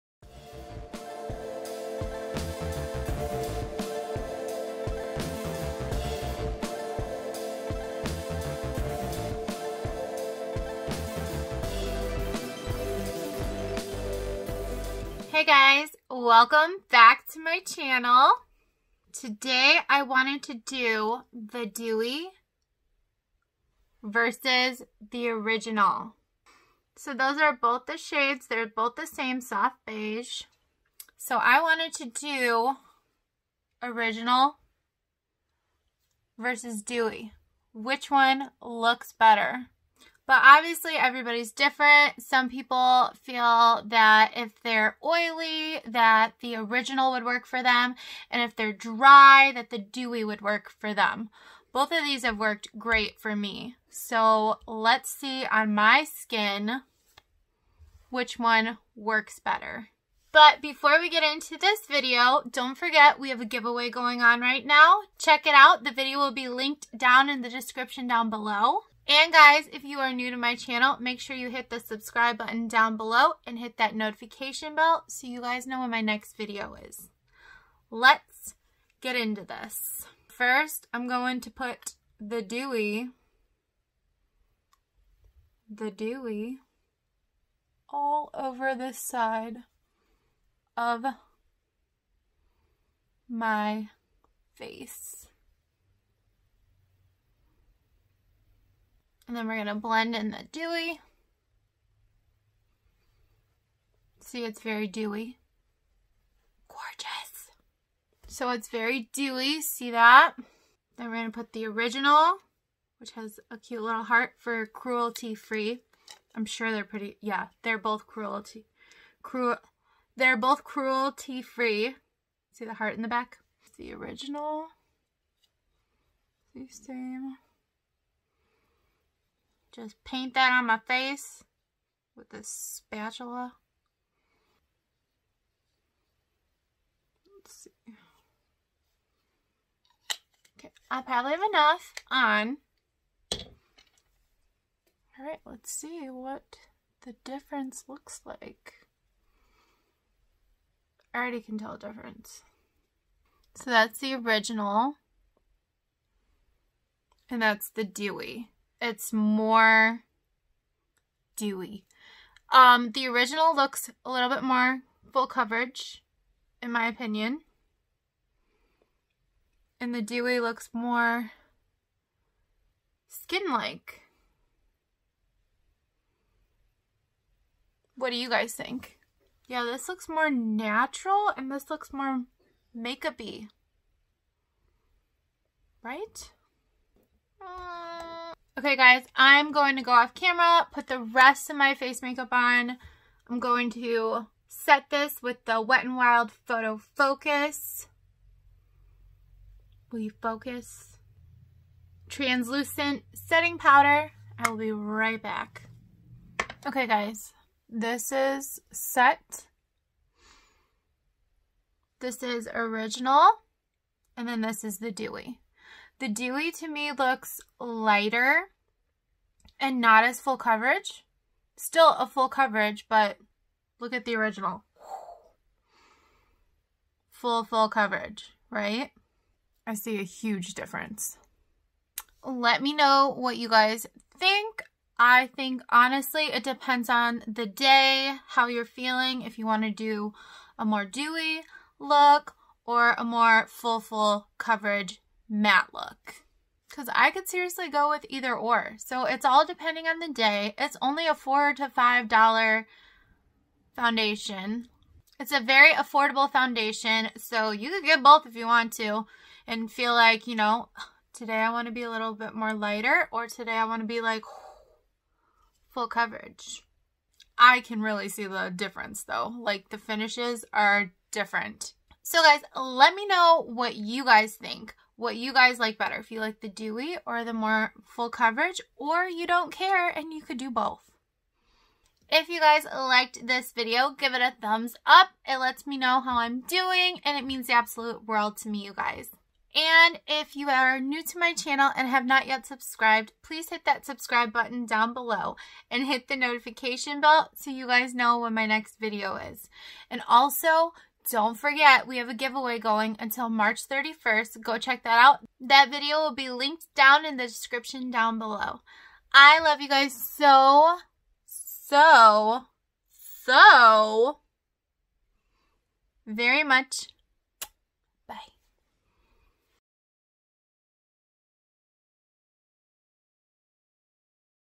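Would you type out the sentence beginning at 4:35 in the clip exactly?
If you like the dewy or the more full coverage, or you don't care and you could do both.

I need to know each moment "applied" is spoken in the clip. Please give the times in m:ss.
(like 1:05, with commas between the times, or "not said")
not said.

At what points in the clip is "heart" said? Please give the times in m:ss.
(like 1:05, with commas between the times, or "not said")
1:54, 2:02.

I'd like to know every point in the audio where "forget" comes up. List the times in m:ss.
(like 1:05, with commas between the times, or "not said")
1:02, 5:01.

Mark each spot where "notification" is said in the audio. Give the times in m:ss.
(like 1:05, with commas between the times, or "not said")
1:13, 4:56.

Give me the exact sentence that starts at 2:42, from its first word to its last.
Um, the original looks a little bit more full coverage, in my opinion.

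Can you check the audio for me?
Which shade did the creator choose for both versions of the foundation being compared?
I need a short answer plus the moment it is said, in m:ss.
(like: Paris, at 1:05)
Soft beige, at 0:29.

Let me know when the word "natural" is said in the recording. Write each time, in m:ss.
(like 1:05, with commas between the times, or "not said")
3:00.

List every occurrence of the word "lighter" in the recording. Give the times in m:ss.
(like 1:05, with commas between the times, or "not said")
3:37, 4:22.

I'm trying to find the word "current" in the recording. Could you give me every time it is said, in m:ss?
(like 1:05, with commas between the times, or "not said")
not said.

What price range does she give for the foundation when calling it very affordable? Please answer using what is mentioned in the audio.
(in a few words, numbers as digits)
$4 to $5.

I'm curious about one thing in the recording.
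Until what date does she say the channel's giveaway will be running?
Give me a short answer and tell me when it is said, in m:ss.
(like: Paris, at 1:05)
March 31st, at 5:03.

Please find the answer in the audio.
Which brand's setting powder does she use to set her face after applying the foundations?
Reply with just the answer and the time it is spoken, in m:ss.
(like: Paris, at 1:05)
Wet n Wild, at 3:15.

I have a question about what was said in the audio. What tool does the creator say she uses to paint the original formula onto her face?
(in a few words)
Spatula.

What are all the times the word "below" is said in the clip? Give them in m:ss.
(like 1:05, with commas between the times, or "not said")
1:08, 1:12, 4:54, 5:08.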